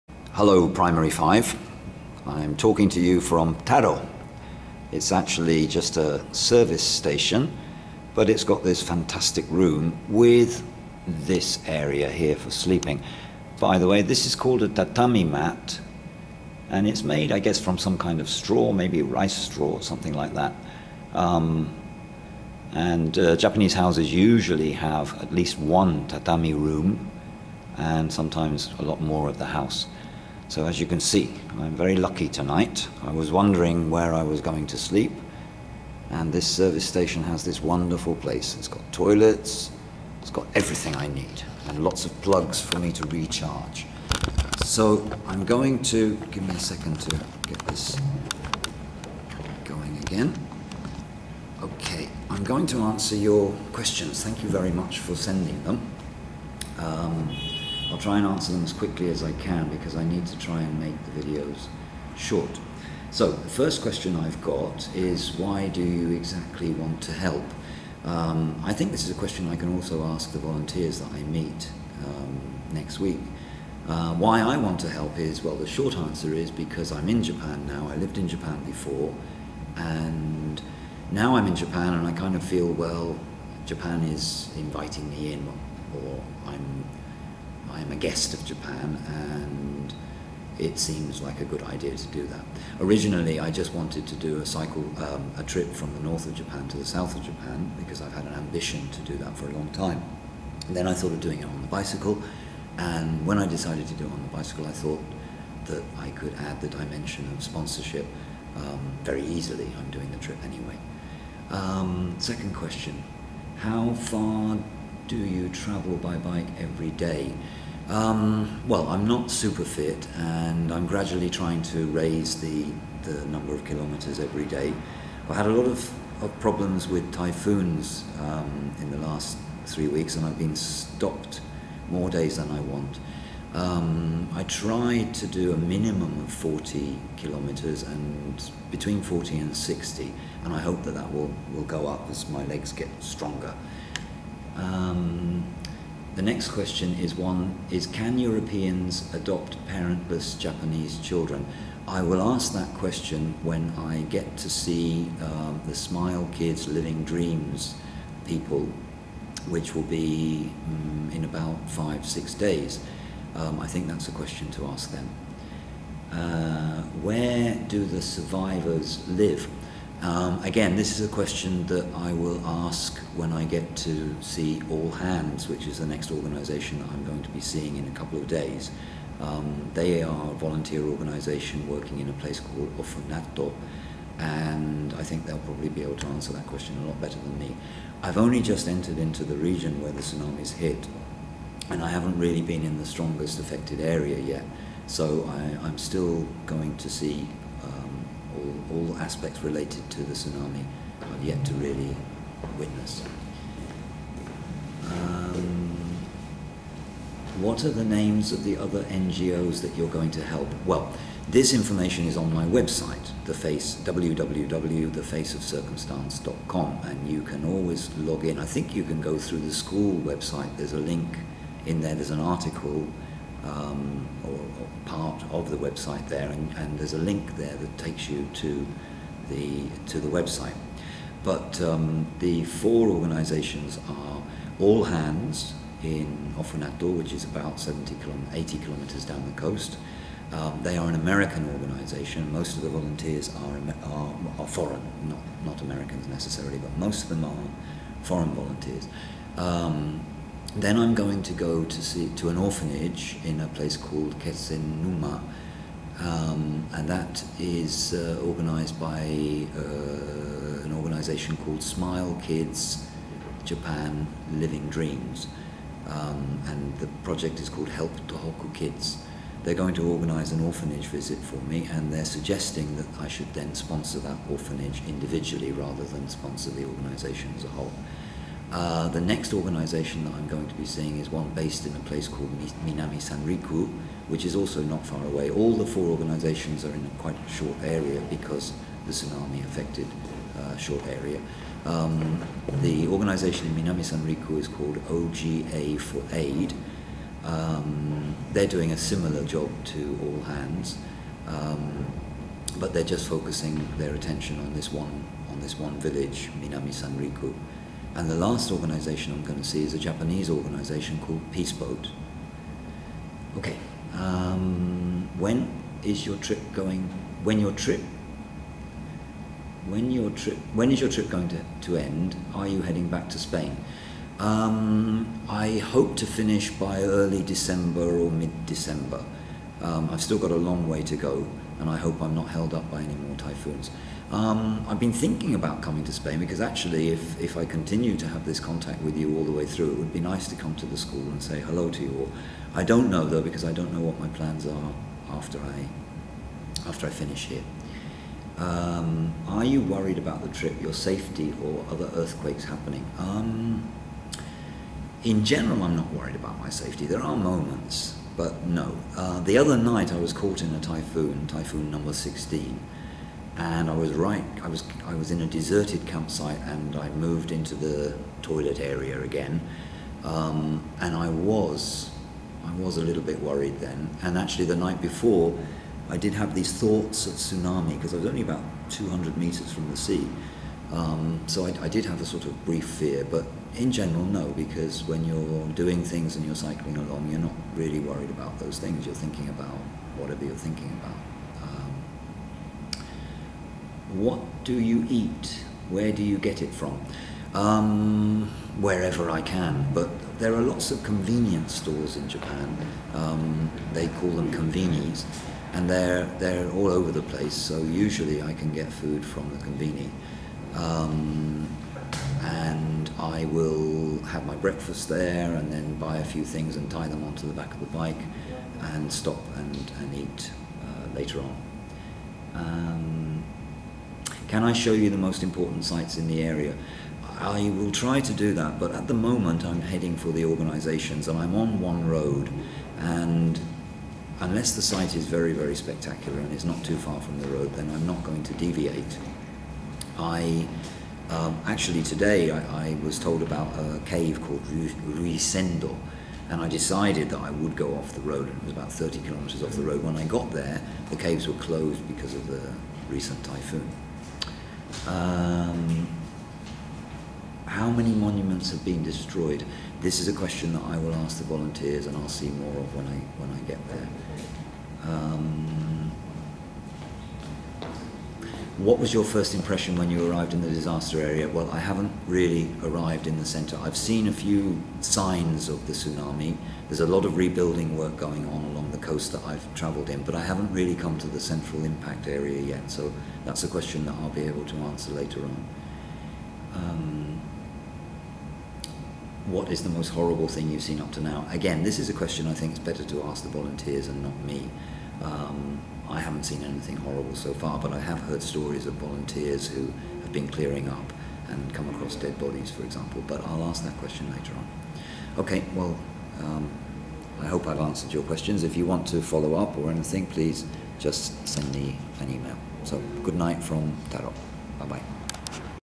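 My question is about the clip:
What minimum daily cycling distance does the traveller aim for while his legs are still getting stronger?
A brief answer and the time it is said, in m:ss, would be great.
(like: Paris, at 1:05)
40 kilometres, at 2:16.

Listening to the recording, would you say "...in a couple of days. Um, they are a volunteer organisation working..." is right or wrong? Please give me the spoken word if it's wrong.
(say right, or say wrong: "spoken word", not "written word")
right.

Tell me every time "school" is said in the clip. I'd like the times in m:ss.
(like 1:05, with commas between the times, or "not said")
3:39, 5:40.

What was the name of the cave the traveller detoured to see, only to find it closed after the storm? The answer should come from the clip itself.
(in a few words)
Ryusendo.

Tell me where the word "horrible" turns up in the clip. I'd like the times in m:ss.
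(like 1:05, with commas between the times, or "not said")
8:09, 8:16.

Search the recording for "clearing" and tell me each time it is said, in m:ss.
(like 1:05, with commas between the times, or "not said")
8:20.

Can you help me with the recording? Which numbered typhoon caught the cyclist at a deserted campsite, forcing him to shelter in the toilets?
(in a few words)
typhoon number 16.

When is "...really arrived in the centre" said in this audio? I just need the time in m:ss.
7:52.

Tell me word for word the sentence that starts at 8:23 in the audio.
But I'll ask that question later on.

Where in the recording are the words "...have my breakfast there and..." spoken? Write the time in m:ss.
6:54.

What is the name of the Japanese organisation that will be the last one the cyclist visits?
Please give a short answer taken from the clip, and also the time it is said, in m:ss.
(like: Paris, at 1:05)
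Peace Boat, at 5:11.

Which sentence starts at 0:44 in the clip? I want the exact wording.
So I'm going to, give me a second to get this going again.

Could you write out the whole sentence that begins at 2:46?
Uh, where do the survivors live?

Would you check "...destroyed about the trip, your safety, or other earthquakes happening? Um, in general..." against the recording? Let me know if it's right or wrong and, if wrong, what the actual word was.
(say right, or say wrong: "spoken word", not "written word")
wrong: "worried", not "destroyed".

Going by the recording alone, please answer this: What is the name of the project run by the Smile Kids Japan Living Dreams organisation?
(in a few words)
Help Tohoku Kids.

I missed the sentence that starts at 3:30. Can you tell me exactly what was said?
Well, this information is on my website, the face www.thefaceofcircumstance.com, and you can always log in.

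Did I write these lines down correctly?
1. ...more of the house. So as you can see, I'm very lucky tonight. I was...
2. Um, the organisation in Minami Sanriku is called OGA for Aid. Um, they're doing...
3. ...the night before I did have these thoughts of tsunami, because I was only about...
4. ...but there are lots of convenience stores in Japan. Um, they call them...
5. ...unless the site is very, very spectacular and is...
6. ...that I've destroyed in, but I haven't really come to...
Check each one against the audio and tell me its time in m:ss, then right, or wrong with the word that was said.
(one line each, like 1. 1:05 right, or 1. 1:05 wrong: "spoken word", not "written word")
1. 0:29 right
2. 4:51 right
3. 6:14 right
4. 6:39 right
5. 7:14 right
6. 7:59 wrong: "travelled", not "destroyed".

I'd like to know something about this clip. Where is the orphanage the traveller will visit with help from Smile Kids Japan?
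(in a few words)
Kesennuma.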